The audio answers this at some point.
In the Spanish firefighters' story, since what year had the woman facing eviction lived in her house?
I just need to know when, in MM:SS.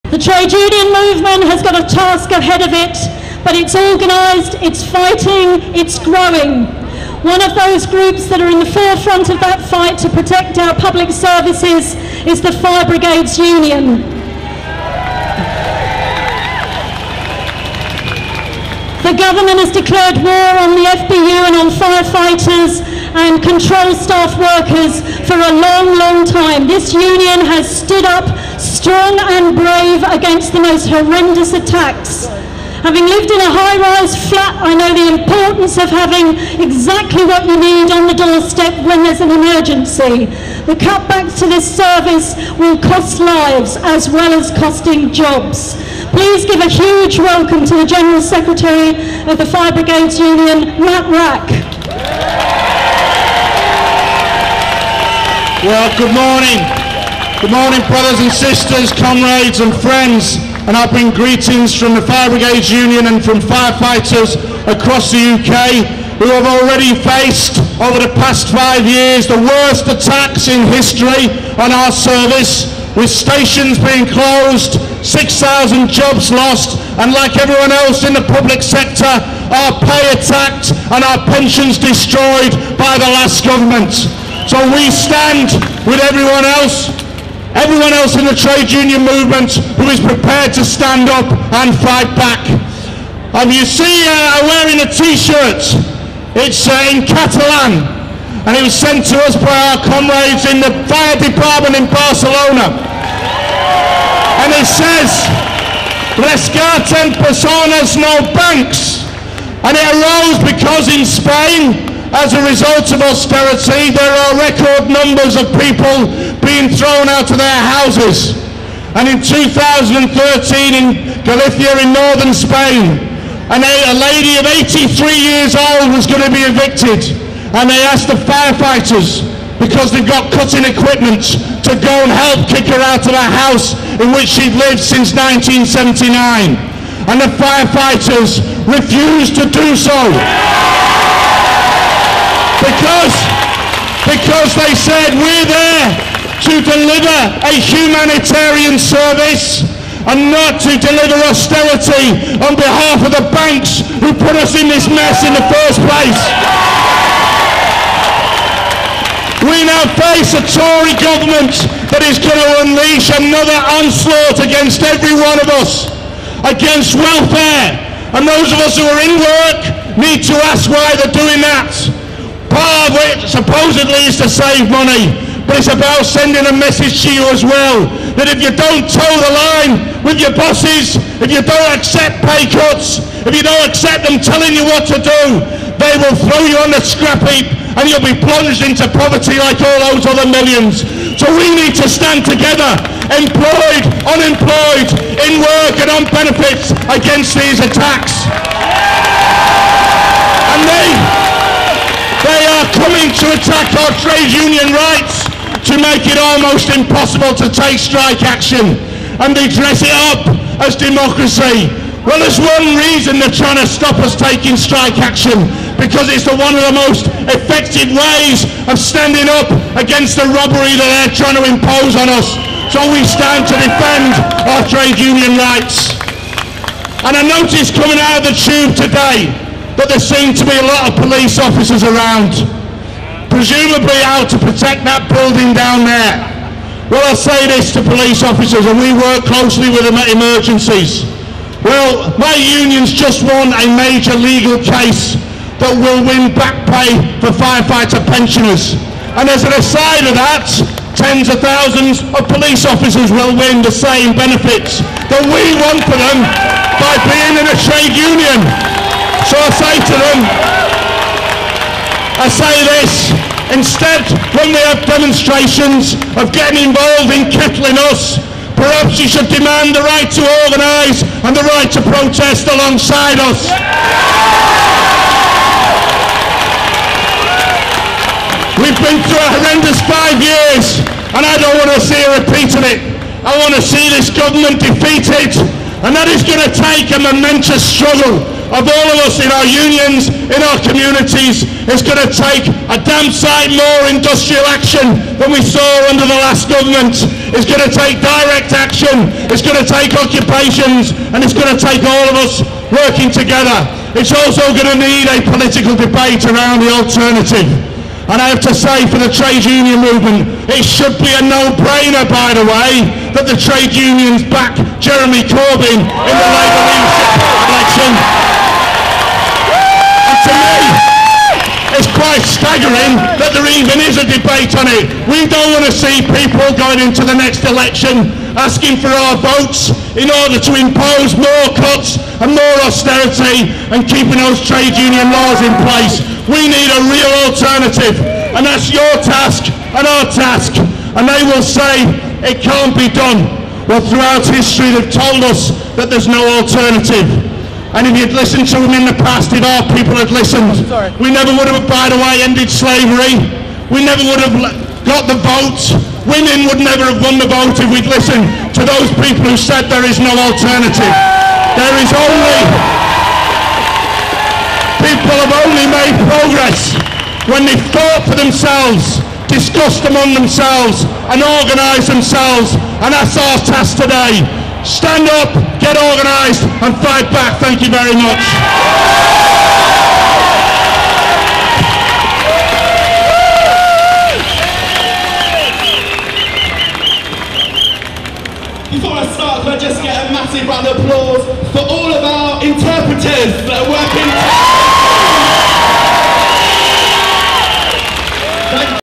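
02:15.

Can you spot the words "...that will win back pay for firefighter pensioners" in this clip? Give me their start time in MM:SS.
04:05.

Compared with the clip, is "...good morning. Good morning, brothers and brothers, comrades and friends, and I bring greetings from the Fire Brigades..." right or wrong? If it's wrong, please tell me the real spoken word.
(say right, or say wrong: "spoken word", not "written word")
wrong: "sisters", not "brothers".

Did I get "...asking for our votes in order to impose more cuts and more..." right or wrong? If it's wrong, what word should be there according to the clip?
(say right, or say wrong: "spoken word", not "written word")
right.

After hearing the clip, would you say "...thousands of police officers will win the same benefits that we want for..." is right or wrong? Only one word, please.
right.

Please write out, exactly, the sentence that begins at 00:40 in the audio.
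The cutbacks to this service will cost lives as well as costing jobs.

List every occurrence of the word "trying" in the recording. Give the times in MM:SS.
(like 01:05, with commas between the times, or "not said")
03:33, 03:41.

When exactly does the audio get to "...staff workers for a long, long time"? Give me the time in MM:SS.
00:23.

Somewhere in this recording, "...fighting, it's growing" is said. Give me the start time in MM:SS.
00:04.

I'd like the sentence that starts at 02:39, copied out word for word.
We now face a Tory government that is going to unleash another onslaught against every one of us, against welfare.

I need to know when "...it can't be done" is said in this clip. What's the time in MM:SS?
05:42.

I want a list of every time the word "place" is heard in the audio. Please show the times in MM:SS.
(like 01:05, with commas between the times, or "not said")
02:35, 05:35.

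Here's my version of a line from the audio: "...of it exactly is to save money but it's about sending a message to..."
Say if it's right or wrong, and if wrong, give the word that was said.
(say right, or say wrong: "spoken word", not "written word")
wrong: "supposedly", not "exactly".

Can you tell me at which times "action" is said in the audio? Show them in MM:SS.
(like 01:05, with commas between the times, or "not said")
03:28, 03:34, 04:54, 04:58.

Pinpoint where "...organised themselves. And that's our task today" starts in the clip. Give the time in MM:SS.
06:11.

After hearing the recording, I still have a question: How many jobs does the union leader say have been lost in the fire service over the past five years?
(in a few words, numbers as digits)
6000.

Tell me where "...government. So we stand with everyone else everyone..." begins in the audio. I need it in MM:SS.
01:23.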